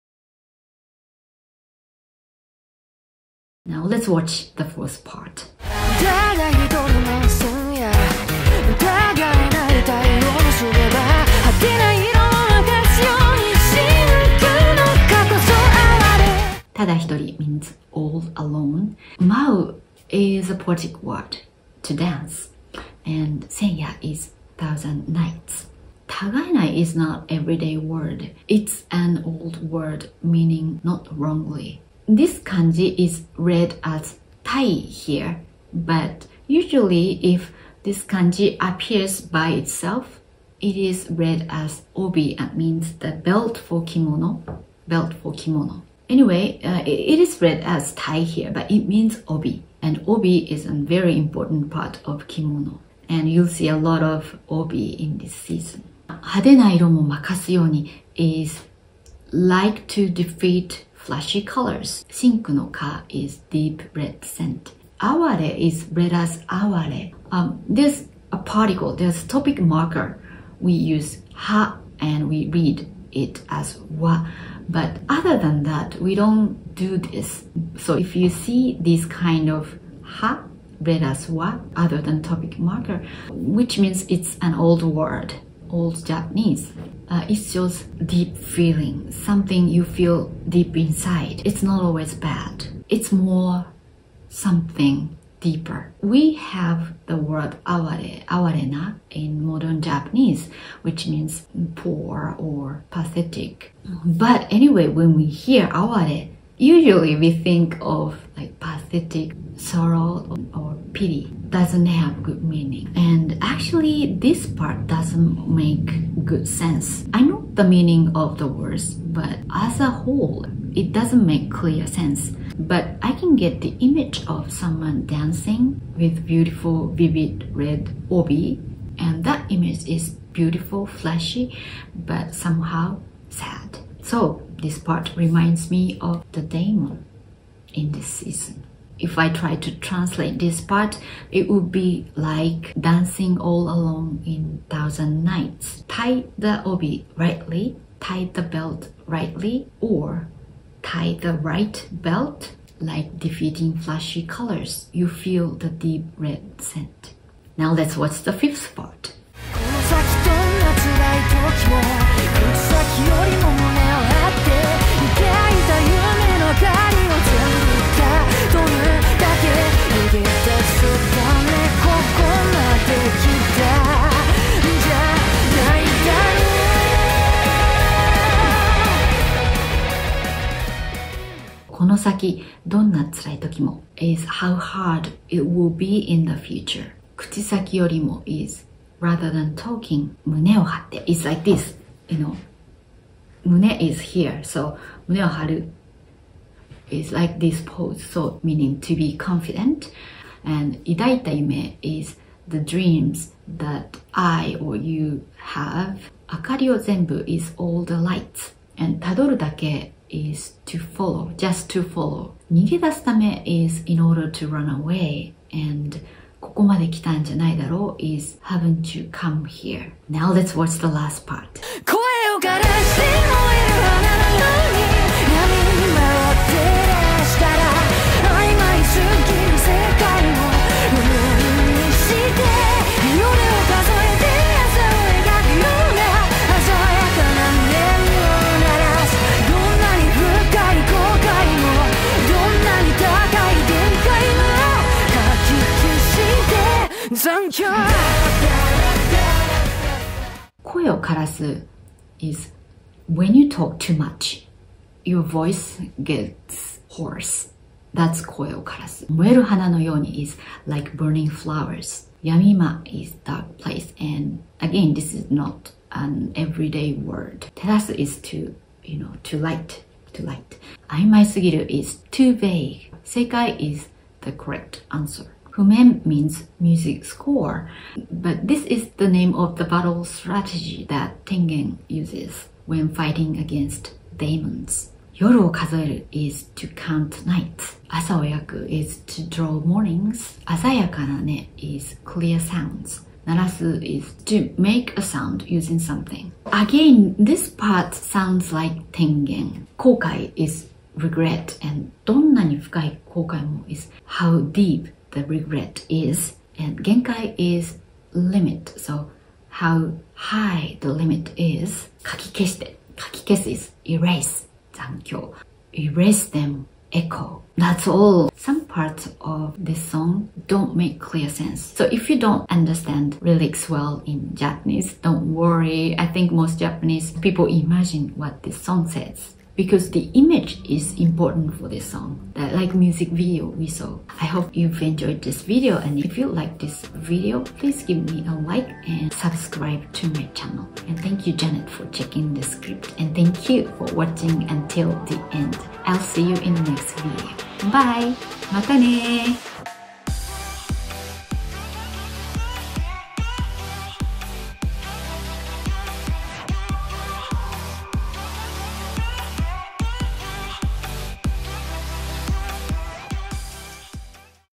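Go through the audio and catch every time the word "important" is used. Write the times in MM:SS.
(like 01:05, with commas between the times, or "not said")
00:51, 05:30.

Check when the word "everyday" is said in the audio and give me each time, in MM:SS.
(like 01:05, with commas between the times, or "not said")
00:27, 04:26.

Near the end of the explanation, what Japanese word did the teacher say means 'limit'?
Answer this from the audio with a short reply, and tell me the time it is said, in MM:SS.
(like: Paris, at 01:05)
genkai, at 05:06.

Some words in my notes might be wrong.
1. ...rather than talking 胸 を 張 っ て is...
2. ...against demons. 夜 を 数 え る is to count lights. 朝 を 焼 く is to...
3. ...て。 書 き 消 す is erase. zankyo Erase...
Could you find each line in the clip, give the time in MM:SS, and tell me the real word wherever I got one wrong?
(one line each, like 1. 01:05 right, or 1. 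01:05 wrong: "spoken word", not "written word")
1. 03:08 right
2. 04:43 wrong: "nights", not "lights"
3. 05:12 right.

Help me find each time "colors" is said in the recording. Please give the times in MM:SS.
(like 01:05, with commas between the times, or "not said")
01:01, 02:34.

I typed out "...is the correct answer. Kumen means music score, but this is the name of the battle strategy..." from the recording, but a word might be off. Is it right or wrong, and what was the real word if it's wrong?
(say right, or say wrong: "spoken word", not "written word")
right.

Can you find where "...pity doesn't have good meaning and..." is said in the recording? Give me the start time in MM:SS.
01:50.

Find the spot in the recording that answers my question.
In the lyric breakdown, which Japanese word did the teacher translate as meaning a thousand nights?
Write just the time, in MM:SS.
00:23.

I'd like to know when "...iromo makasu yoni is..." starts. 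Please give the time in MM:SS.
00:56.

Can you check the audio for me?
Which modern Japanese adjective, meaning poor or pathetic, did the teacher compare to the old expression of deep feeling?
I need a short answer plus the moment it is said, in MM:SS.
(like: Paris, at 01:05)
awarena, at 01:38.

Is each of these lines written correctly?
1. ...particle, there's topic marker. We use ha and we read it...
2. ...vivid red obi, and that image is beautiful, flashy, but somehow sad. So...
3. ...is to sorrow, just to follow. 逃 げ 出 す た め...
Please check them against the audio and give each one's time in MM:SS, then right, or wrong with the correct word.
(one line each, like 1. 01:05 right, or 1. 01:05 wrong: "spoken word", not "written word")
1. 01:08 right
2. 02:06 right
3. 03:30 wrong: "follow", not "sorrow".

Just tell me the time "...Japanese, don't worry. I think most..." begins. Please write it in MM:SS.
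05:24.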